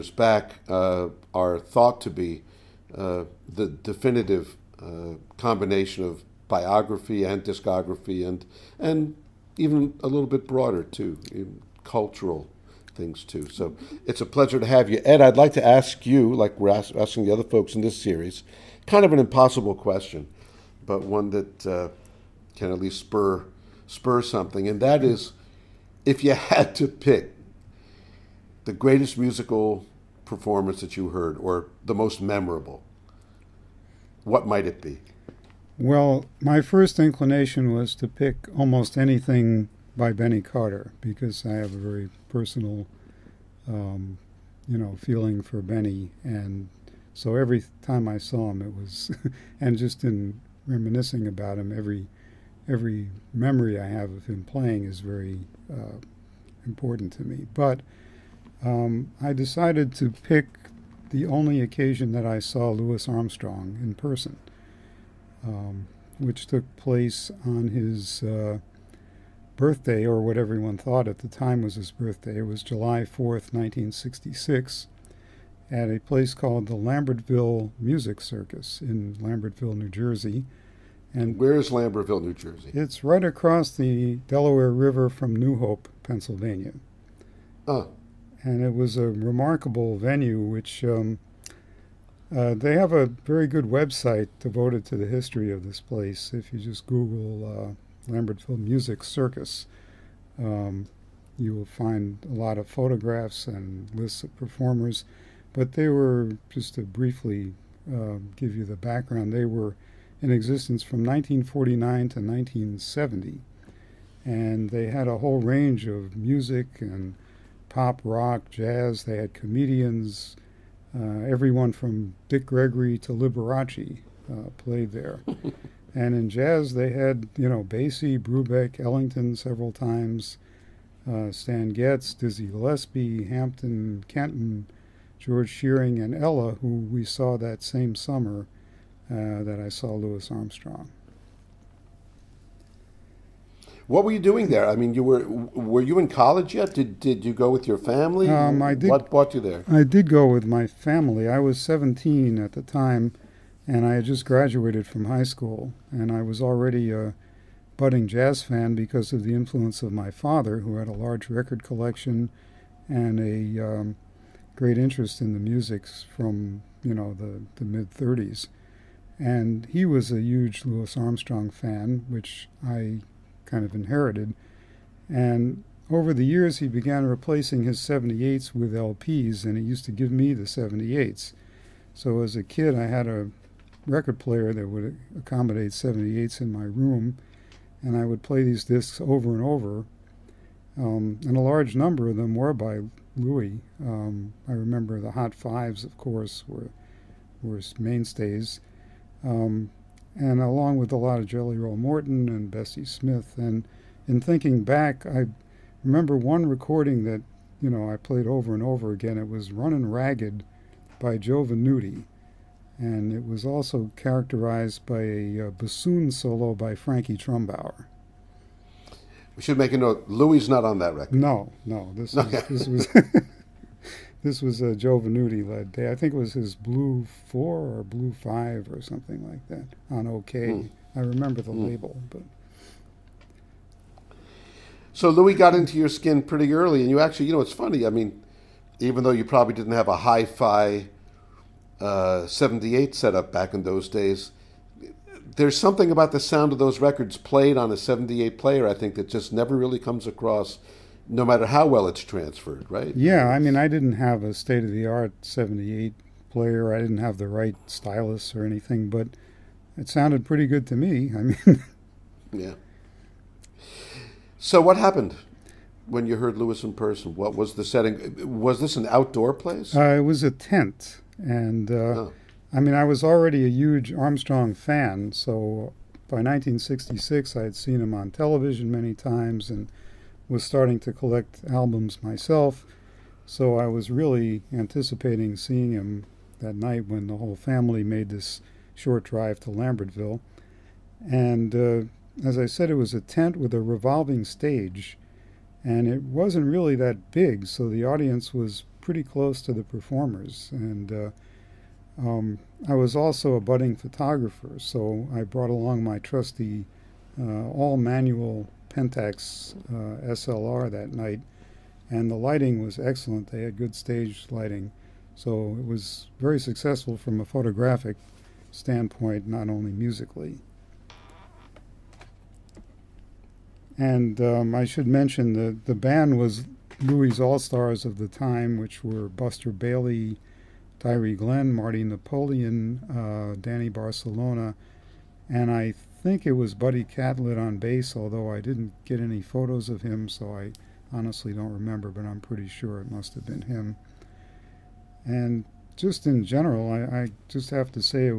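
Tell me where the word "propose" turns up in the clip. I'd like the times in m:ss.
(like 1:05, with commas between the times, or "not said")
not said.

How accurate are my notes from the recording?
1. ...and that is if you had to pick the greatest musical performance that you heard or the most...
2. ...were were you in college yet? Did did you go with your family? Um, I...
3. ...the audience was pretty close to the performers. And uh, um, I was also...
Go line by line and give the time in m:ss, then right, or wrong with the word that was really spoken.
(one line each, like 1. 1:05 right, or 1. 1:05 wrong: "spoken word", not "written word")
1. 0:24 right
2. 2:25 right
3. 4:57 right.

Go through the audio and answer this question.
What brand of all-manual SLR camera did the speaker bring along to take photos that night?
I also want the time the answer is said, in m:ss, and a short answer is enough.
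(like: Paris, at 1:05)
Pentax, at 5:08.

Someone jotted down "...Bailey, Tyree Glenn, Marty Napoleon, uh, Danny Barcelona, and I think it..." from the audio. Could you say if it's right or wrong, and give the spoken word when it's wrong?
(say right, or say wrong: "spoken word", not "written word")
right.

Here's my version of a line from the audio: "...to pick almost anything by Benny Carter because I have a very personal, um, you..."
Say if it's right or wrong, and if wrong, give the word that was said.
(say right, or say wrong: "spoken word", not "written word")
right.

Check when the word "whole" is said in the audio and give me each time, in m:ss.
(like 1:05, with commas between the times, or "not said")
1:55, 4:47.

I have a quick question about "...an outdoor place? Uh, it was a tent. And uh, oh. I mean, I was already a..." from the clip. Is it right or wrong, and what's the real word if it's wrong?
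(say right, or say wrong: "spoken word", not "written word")
right.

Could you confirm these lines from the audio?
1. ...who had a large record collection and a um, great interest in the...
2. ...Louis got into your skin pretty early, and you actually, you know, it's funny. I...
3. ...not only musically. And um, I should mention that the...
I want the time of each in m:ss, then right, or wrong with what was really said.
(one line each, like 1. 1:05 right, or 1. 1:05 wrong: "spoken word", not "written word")
1. 2:40 right
2. 3:55 right
3. 5:19 right.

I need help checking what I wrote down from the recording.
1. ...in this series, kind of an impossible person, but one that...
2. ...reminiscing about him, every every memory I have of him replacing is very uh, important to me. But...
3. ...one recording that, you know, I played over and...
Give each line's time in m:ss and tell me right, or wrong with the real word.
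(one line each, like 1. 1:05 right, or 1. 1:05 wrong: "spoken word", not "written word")
1. 0:17 wrong: "question", not "person"
2. 0:50 wrong: "playing", not "replacing"
3. 3:26 right.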